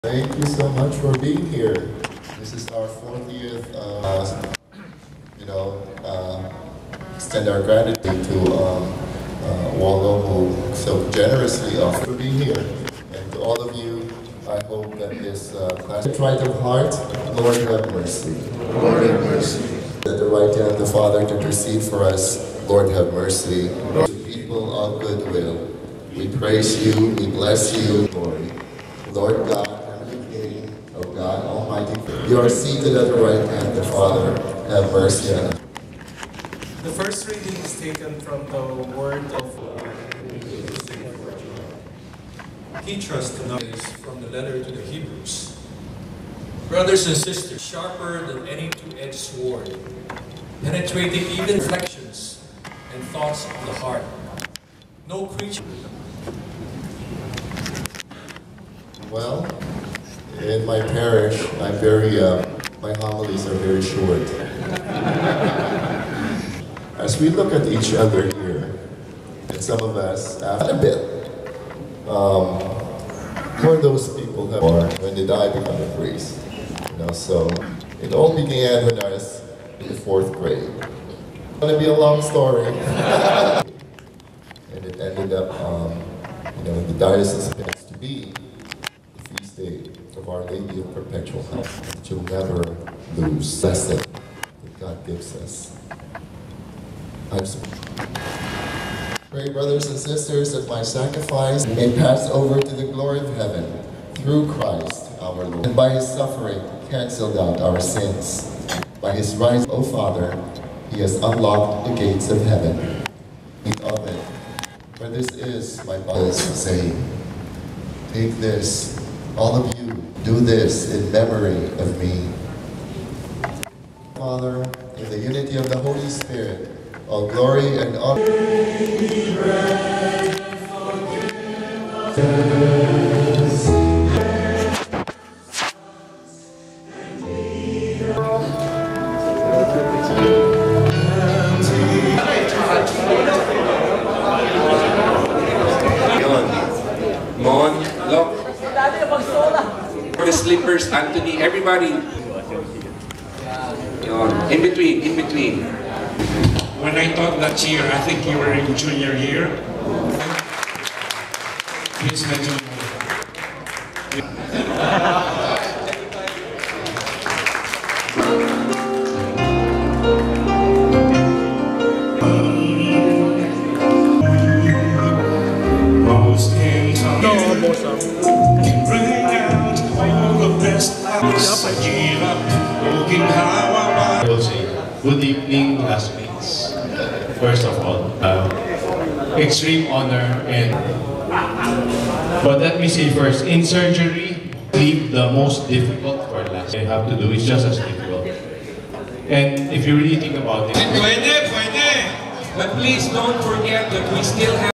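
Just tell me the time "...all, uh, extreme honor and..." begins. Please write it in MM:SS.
03:07.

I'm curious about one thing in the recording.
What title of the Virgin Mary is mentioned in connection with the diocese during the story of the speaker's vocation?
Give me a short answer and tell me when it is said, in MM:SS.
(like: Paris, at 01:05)
Our Lady of Perpetual Help, at 01:30.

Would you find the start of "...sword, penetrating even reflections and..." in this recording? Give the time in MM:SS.
00:49.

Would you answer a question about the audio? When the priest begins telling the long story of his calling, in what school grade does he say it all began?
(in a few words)
fourth grade.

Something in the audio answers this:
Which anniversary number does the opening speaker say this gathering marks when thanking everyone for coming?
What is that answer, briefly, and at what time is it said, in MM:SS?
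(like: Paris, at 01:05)
40th, at 00:02.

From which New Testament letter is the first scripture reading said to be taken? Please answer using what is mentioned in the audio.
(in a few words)
Hebrews.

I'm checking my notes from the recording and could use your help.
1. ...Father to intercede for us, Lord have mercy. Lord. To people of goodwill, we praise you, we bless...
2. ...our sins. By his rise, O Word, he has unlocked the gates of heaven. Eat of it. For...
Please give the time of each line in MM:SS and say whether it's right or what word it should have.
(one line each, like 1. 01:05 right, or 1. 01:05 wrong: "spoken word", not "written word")
1. 00:20 right
2. 01:47 wrong: "Father", not "Word".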